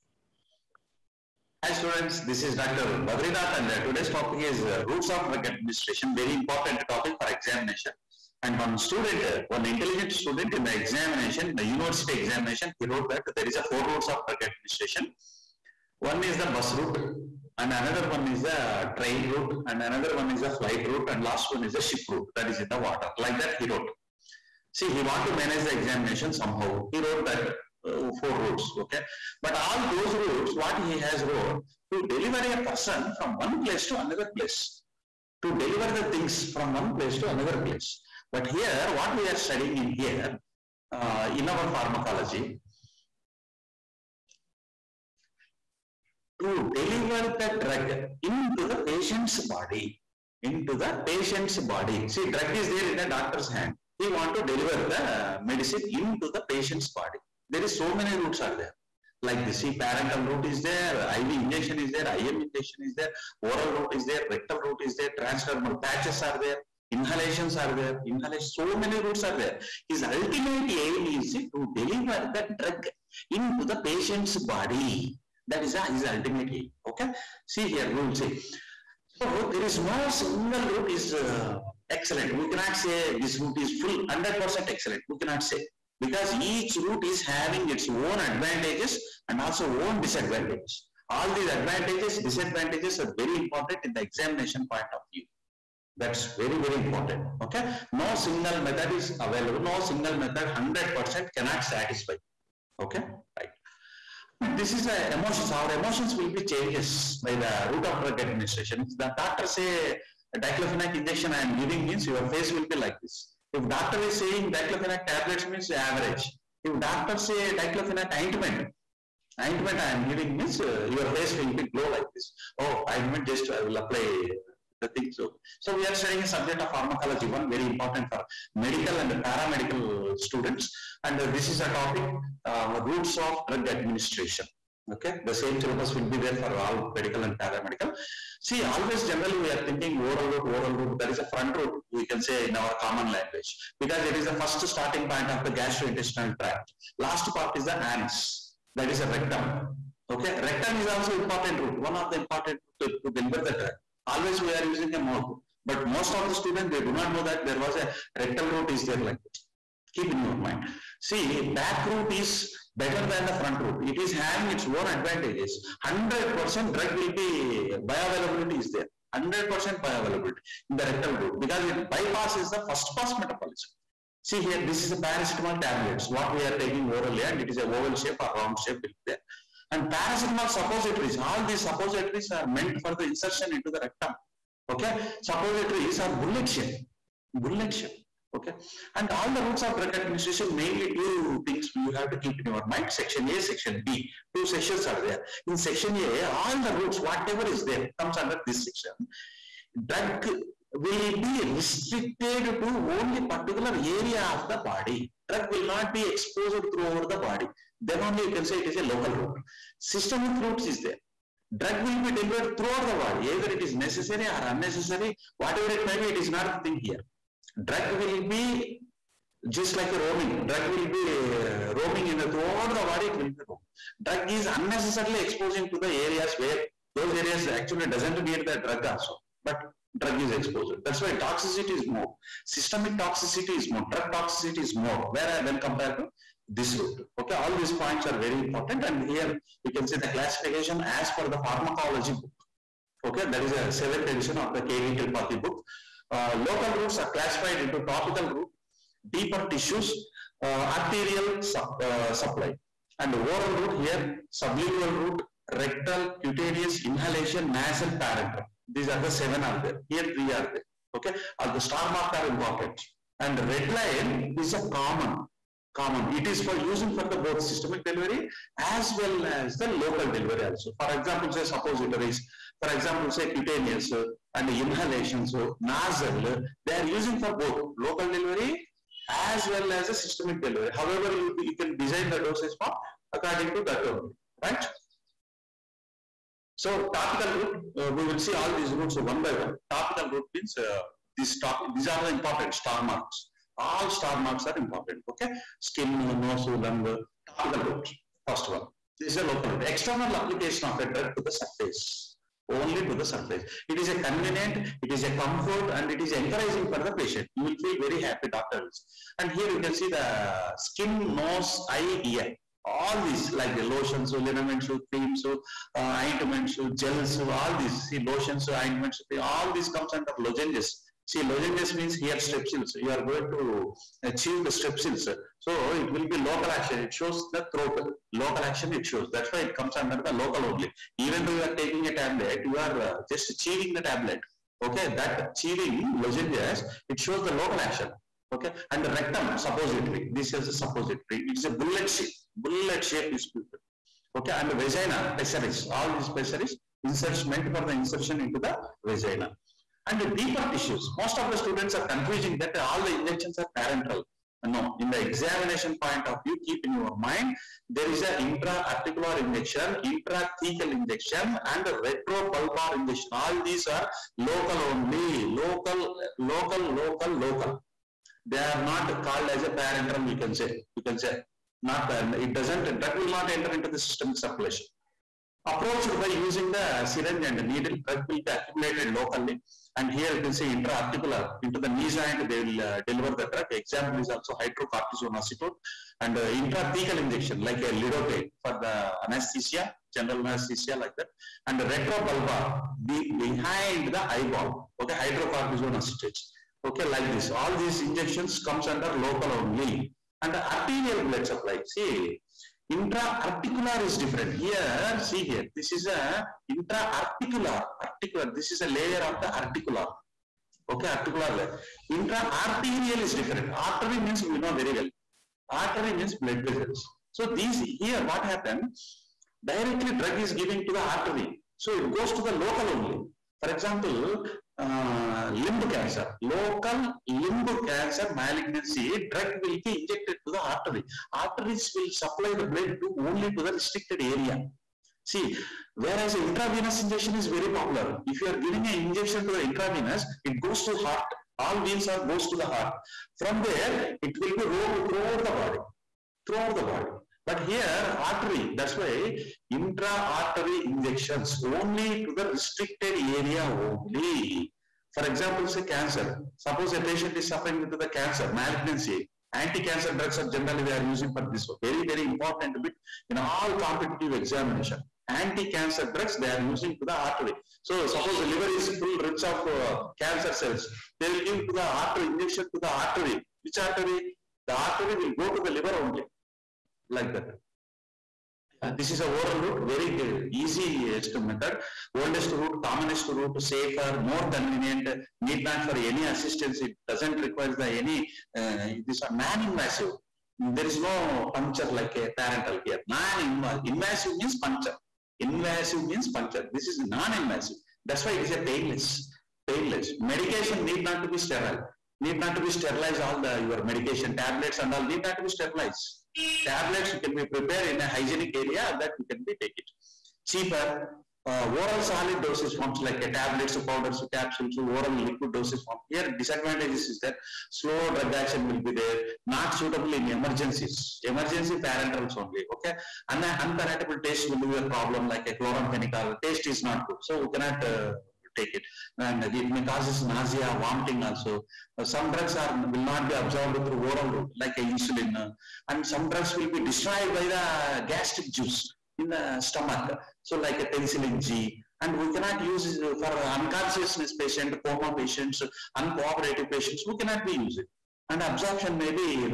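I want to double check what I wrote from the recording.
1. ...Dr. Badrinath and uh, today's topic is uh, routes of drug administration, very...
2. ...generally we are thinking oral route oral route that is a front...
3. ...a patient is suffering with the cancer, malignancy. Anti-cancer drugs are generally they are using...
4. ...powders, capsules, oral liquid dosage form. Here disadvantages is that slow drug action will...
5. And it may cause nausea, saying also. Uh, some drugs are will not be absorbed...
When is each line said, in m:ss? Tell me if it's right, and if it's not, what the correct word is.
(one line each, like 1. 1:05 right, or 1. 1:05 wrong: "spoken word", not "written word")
1. 0:02 right
2. 2:19 right
3. 7:36 right
4. 8:33 right
5. 8:48 wrong: "vomiting", not "saying".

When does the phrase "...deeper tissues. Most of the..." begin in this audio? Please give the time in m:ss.
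5:50.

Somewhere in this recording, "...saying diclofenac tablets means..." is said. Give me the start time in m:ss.
1:54.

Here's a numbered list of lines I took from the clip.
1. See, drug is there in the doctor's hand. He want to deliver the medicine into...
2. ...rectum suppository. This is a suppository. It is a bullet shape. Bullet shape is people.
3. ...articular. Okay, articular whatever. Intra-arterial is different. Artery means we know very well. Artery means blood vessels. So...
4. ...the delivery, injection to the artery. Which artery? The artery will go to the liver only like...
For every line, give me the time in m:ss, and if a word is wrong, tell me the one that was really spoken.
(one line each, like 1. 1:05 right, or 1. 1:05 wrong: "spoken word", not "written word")
1. 0:52 right
2. 5:38 right
3. 6:49 wrong: "layer", not "whatever"
4. 7:51 wrong: "artery", not "delivery".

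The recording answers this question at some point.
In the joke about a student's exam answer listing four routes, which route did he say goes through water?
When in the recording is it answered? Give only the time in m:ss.
0:21.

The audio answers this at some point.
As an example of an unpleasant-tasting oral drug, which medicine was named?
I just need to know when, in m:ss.
8:45.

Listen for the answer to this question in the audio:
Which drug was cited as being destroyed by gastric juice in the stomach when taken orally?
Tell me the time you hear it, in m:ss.
9:00.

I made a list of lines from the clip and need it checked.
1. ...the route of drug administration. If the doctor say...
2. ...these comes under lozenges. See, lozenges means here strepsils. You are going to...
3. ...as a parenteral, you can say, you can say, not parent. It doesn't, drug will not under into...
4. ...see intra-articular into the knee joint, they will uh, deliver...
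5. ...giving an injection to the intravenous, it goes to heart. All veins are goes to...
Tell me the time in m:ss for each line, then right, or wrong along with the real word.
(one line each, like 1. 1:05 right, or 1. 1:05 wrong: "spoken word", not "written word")
1. 1:47 right
2. 5:19 right
3. 6:09 wrong: "enter", not "under"
4. 6:20 right
5. 7:18 right.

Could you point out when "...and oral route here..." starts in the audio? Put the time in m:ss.
4:12.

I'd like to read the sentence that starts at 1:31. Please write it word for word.
All these advantages, disadvantages are very important in the examination point of view.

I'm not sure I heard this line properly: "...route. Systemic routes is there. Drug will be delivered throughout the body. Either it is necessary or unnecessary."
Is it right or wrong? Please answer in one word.
right.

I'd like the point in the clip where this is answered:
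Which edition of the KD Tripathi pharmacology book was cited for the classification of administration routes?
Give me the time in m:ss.
4:03.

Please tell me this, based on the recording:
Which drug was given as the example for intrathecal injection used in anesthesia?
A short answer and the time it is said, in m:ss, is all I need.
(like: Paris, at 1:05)
Lidocaine, at 6:27.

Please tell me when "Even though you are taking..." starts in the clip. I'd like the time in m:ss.
5:30.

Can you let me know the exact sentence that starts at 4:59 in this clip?
External application of a drug to the surface.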